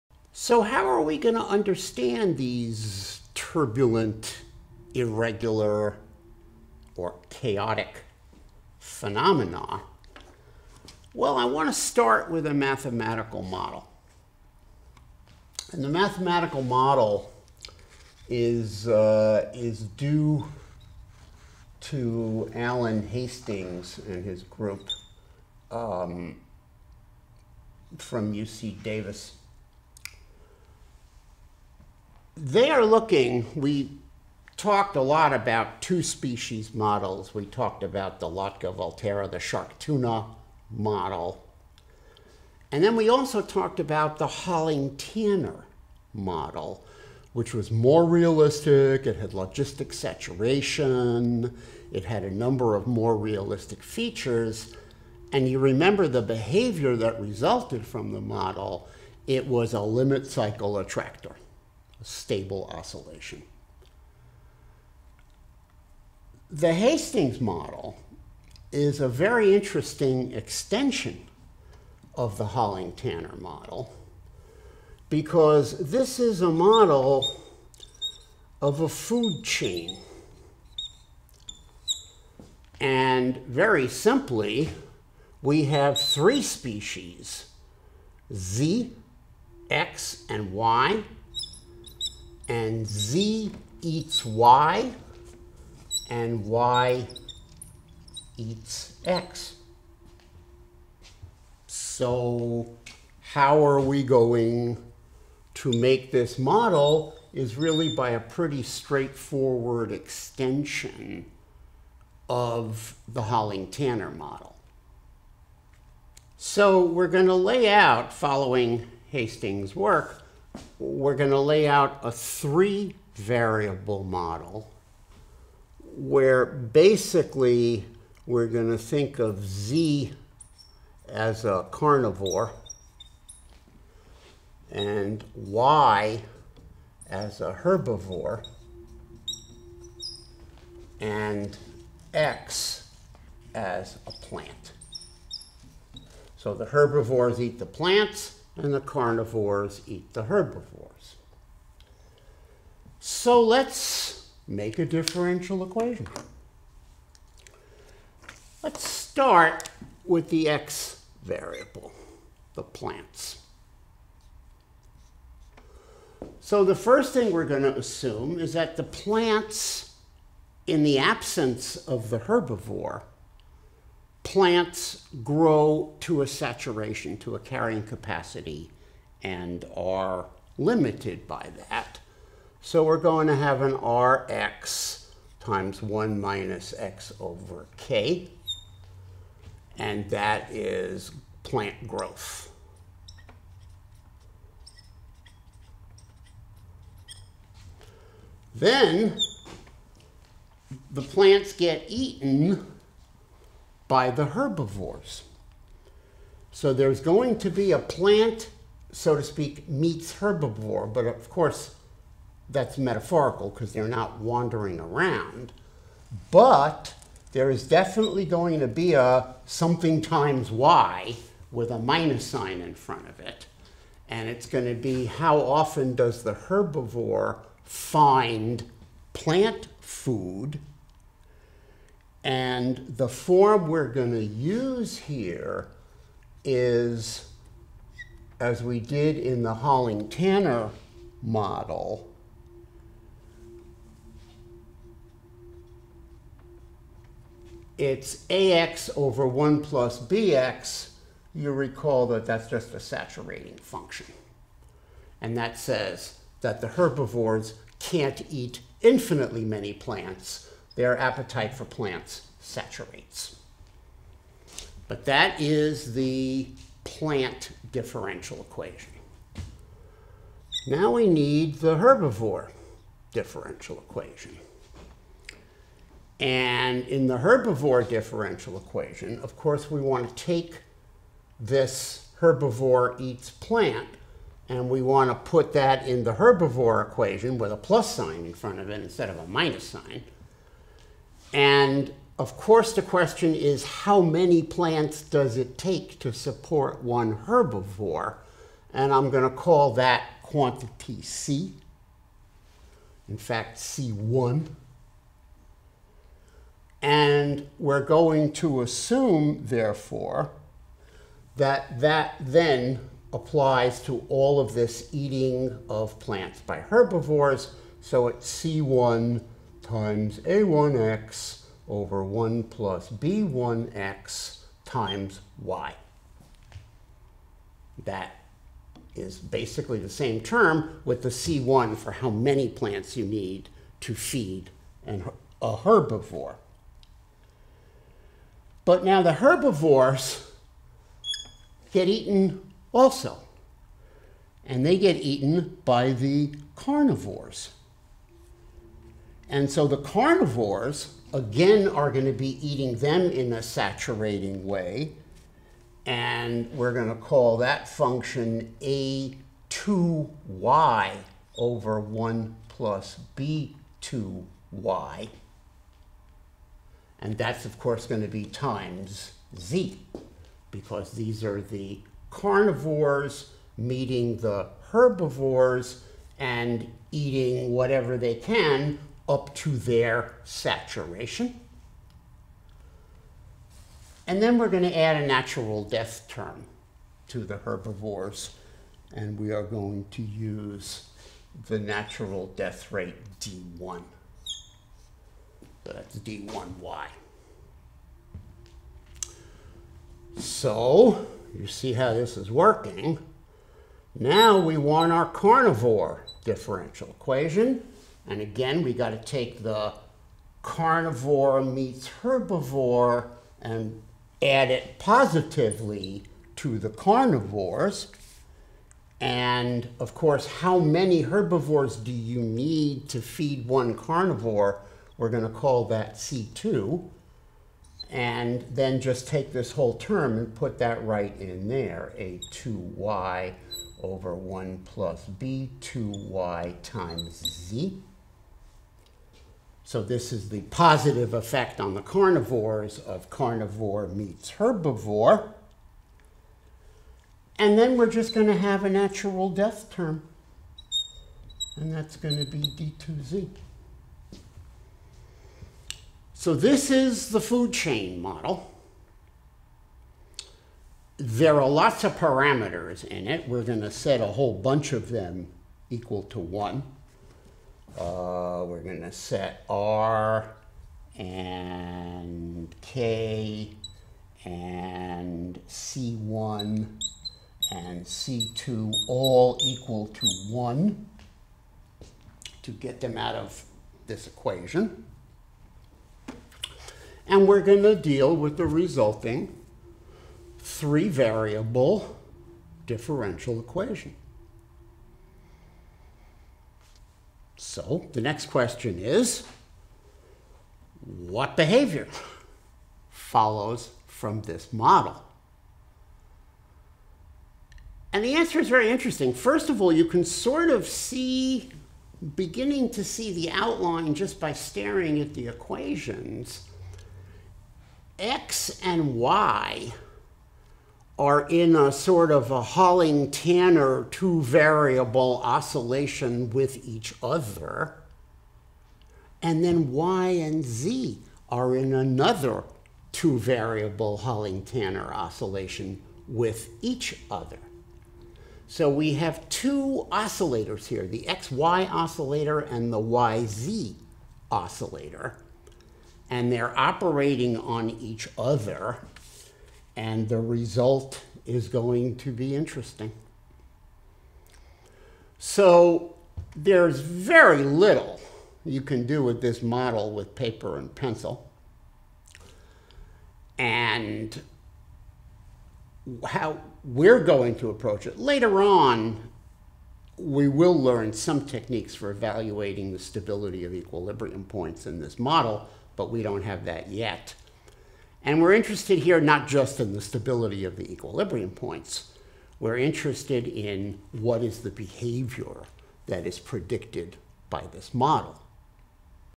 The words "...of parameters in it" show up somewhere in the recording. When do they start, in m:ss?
7:41.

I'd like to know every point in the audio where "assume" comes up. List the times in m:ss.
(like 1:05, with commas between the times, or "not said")
2:47, 5:08.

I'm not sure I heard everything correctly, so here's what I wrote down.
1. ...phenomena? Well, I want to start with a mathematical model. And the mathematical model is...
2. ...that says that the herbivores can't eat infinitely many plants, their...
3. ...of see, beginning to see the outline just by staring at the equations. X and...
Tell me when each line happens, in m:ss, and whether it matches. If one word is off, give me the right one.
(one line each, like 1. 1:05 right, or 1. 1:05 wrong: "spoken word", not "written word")
1. 0:08 right
2. 4:15 right
3. 8:30 right.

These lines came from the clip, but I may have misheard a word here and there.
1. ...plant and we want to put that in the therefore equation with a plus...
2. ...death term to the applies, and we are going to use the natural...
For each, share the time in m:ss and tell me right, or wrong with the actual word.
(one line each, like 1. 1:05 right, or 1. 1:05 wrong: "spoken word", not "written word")
1. 4:43 wrong: "herbivore", not "therefore"
2. 6:25 wrong: "herbivores", not "applies".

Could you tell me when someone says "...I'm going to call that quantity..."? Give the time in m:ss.
4:58.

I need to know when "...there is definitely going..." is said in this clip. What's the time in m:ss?
3:37.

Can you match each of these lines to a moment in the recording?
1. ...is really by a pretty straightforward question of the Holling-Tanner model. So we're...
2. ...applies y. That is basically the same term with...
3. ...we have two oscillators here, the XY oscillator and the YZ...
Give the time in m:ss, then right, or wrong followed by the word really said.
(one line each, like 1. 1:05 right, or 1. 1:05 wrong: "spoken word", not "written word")
1. 1:47 wrong: "extension", not "question"
2. 5:24 wrong: "times", not "applies"
3. 8:58 right.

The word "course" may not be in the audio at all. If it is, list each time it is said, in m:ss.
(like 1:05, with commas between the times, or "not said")
3:31, 4:39, 4:52, 6:07, 6:59.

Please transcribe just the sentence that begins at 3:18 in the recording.
Then the plants get eaten by the herbivores.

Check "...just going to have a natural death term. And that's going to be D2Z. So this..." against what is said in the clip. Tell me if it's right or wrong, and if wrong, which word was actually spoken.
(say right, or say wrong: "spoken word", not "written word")
right.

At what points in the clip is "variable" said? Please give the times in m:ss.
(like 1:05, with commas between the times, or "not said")
2:03, 2:41, 8:10, 8:44, 8:53.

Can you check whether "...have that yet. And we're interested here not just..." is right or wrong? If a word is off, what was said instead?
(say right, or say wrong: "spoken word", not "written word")
right.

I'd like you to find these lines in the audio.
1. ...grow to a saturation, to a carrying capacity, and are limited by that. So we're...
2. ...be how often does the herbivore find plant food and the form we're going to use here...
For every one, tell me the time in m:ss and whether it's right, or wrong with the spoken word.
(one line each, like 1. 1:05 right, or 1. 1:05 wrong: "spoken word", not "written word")
1. 2:55 right
2. 3:44 right.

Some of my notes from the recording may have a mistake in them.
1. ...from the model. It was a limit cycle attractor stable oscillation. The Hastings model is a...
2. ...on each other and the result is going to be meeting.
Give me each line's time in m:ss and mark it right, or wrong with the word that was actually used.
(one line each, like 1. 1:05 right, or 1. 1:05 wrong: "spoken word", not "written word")
1. 0:57 right
2. 9:07 wrong: "interesting", not "meeting".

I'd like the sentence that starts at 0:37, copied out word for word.
We talked about the Lotka volterra, the shark tuna model.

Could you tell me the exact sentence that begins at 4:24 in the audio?
But that is the plant differential equation.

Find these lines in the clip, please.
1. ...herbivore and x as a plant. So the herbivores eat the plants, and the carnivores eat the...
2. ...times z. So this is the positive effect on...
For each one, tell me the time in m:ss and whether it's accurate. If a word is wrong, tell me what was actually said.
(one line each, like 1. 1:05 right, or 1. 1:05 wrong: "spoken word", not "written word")
1. 2:17 right
2. 7:16 right.